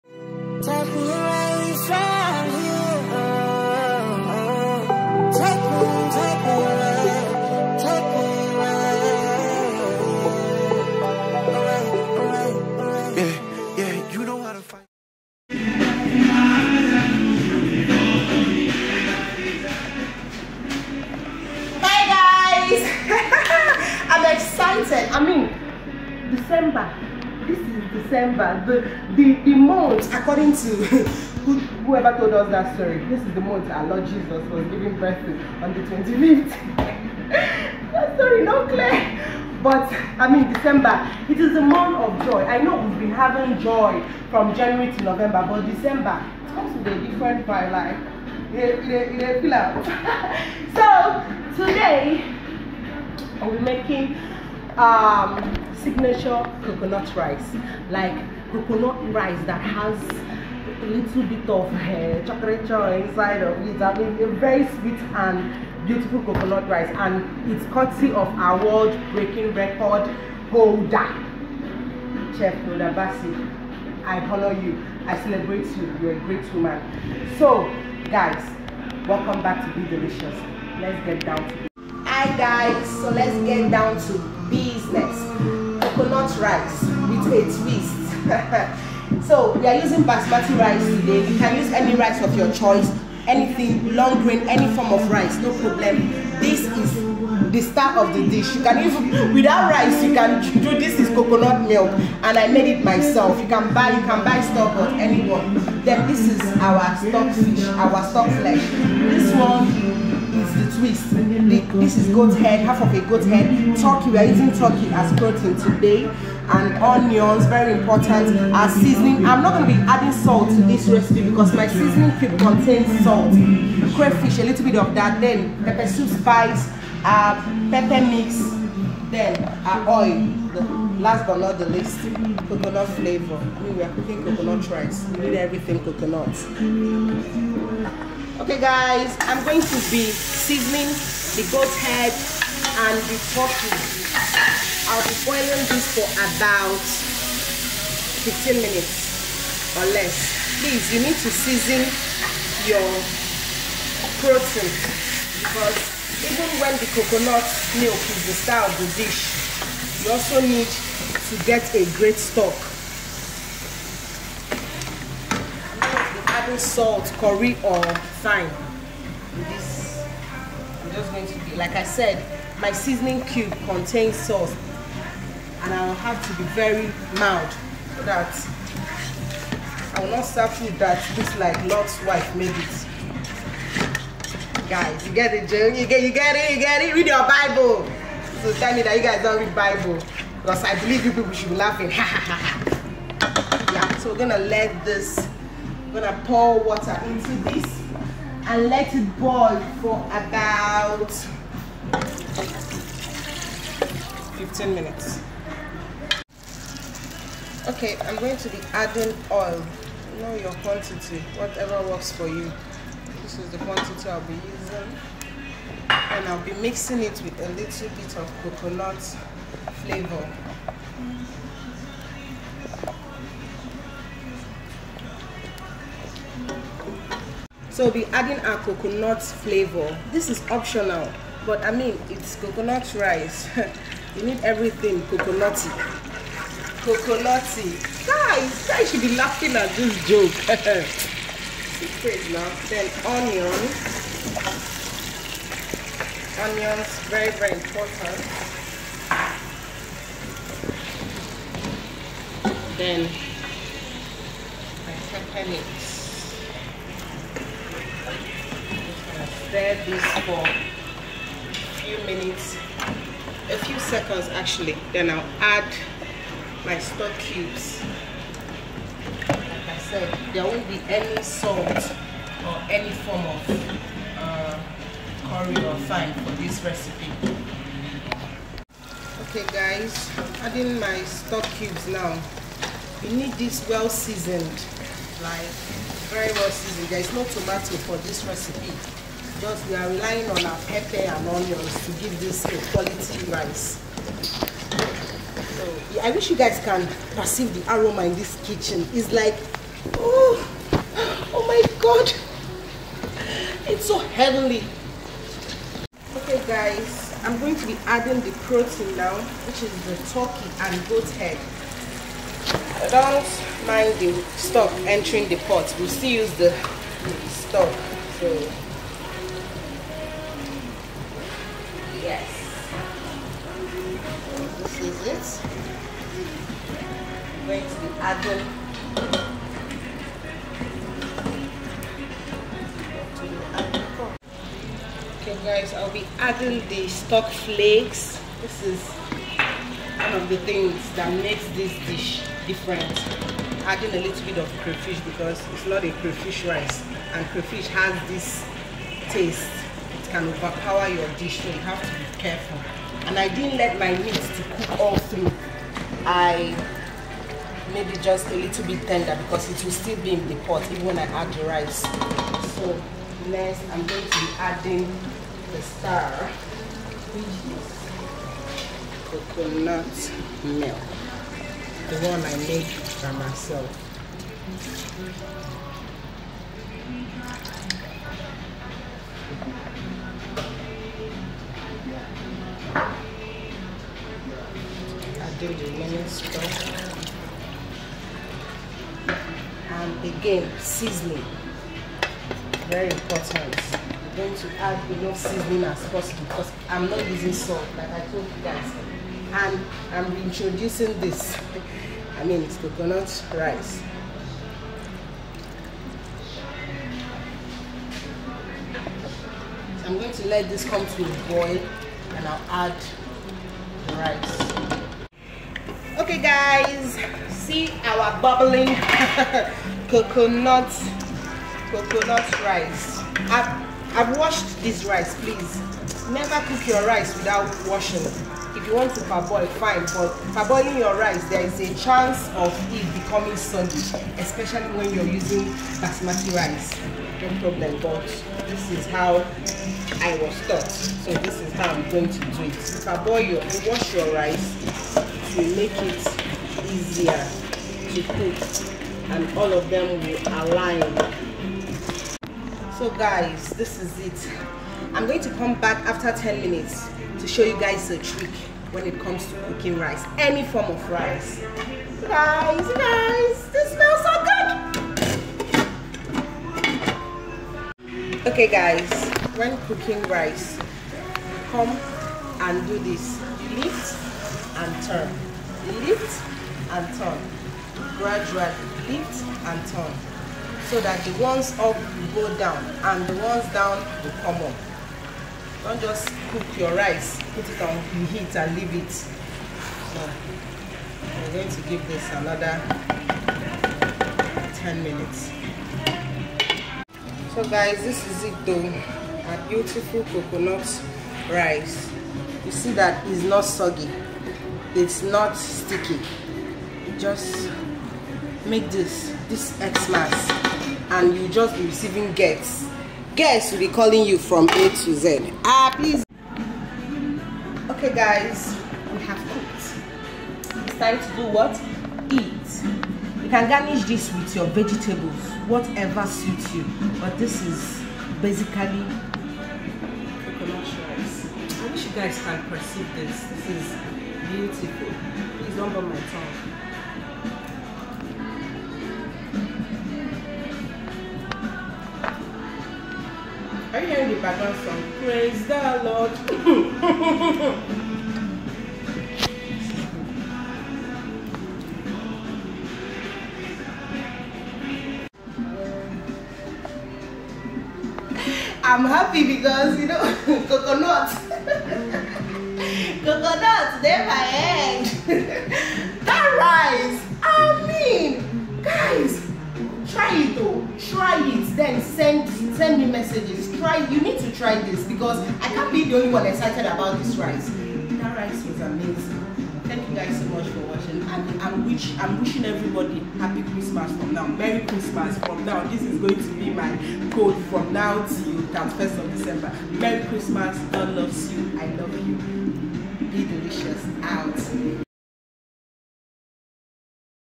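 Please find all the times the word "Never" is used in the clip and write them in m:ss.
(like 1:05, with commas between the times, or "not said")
7:06.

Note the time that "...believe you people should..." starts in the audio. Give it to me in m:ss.
3:10.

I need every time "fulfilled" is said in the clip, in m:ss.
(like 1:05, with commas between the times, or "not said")
not said.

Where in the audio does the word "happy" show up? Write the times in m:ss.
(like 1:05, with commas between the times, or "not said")
9:18, 9:43.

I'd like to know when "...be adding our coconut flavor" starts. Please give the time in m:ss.
3:47.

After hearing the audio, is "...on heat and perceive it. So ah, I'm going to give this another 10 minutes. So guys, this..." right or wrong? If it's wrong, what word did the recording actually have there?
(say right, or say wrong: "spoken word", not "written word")
wrong: "leave", not "perceive".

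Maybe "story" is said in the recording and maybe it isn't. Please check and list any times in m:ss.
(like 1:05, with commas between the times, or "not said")
0:32, 0:38.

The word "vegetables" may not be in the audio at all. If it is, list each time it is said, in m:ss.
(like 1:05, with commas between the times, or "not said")
8:44.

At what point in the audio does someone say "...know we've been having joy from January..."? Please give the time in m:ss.
0:42.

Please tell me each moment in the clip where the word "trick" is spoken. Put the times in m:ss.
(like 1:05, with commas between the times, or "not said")
7:37.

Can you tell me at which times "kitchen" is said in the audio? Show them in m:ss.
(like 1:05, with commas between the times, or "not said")
4:58.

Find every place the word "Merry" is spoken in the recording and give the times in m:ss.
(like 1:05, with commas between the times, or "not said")
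9:44, 9:49.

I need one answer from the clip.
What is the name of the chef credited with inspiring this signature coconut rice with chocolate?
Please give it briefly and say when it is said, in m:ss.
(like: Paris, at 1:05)
Chef Nodabasi, at 1:12.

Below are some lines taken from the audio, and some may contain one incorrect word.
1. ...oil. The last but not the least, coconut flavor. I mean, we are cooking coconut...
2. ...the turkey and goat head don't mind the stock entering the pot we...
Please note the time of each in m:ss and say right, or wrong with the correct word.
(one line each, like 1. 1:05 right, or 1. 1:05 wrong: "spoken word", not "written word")
1. 2:09 right
2. 5:09 right.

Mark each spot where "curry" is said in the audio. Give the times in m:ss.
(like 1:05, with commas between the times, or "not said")
2:47, 4:35.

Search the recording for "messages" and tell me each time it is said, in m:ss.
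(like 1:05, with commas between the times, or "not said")
9:32.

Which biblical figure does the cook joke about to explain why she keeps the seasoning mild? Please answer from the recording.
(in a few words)
Lot's wife.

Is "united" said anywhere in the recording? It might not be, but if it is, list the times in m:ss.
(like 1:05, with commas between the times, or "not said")
not said.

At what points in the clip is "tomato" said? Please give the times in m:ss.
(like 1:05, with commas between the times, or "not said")
4:47.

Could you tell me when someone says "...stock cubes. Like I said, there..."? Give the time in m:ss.
4:26.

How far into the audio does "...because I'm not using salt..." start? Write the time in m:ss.
6:36.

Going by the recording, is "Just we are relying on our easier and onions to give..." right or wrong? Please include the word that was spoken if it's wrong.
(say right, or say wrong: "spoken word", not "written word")
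wrong: "pepper", not "easier".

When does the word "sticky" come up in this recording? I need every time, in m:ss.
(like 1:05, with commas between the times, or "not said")
8:25.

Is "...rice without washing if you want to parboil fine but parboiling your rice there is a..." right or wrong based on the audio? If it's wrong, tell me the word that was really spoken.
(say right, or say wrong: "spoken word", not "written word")
right.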